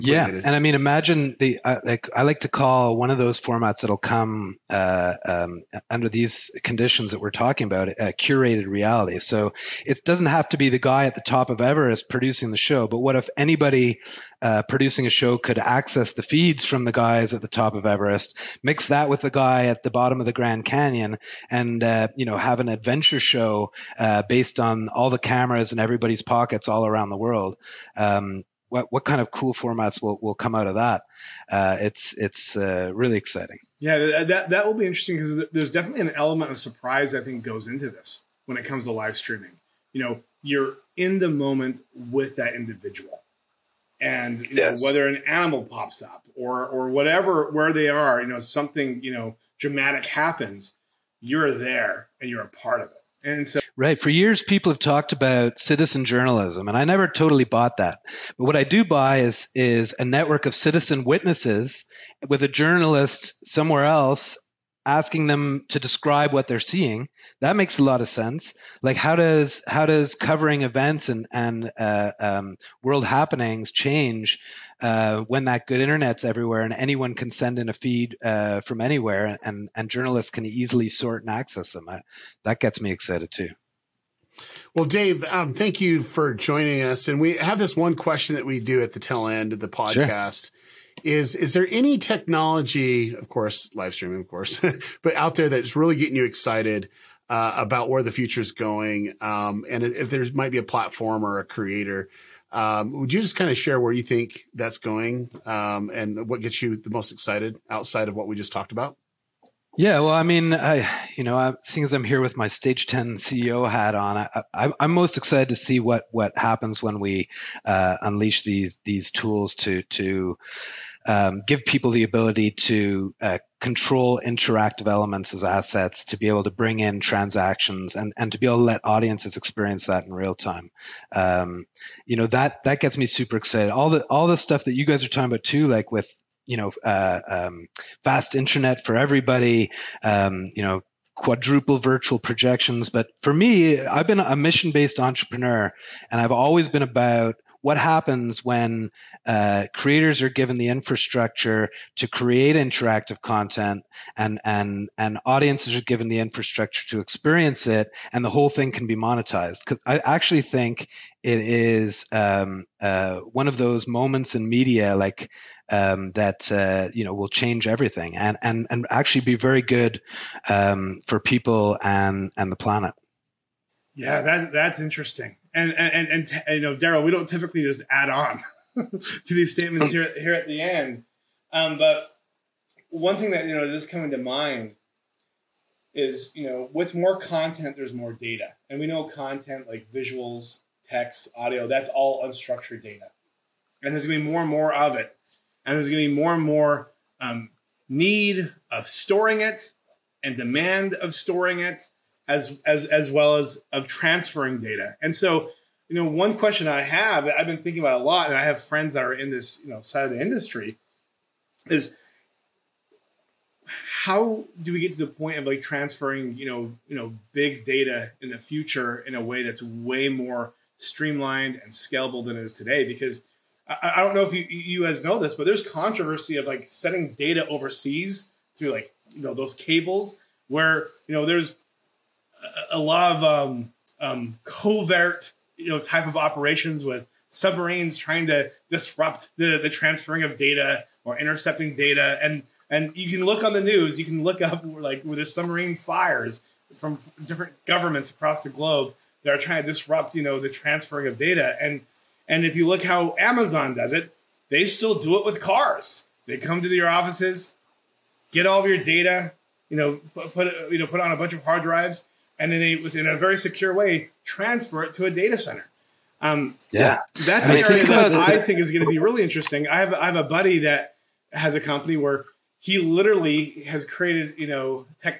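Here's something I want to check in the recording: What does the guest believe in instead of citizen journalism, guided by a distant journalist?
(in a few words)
citizen witnesses.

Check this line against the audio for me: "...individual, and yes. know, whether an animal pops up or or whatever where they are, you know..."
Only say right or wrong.
right.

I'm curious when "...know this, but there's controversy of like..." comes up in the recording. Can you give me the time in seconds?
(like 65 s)
225 s.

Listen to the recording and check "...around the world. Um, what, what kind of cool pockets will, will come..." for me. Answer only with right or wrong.
wrong.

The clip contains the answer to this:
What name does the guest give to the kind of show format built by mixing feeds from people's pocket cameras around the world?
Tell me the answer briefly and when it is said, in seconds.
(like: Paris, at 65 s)
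curated reality, at 8 s.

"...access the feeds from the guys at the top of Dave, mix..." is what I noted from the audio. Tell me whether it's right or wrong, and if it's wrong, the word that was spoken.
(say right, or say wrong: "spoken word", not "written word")
wrong: "Everest", not "Dave".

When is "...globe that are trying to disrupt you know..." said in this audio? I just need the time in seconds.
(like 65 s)
248 s.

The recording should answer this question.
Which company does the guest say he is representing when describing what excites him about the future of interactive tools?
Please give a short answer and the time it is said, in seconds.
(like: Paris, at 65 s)
Stage 10, at 112 s.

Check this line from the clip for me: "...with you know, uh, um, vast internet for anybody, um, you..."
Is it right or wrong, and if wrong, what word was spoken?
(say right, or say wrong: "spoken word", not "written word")
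wrong: "everybody", not "anybody".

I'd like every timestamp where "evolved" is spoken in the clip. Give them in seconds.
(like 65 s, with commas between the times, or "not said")
not said.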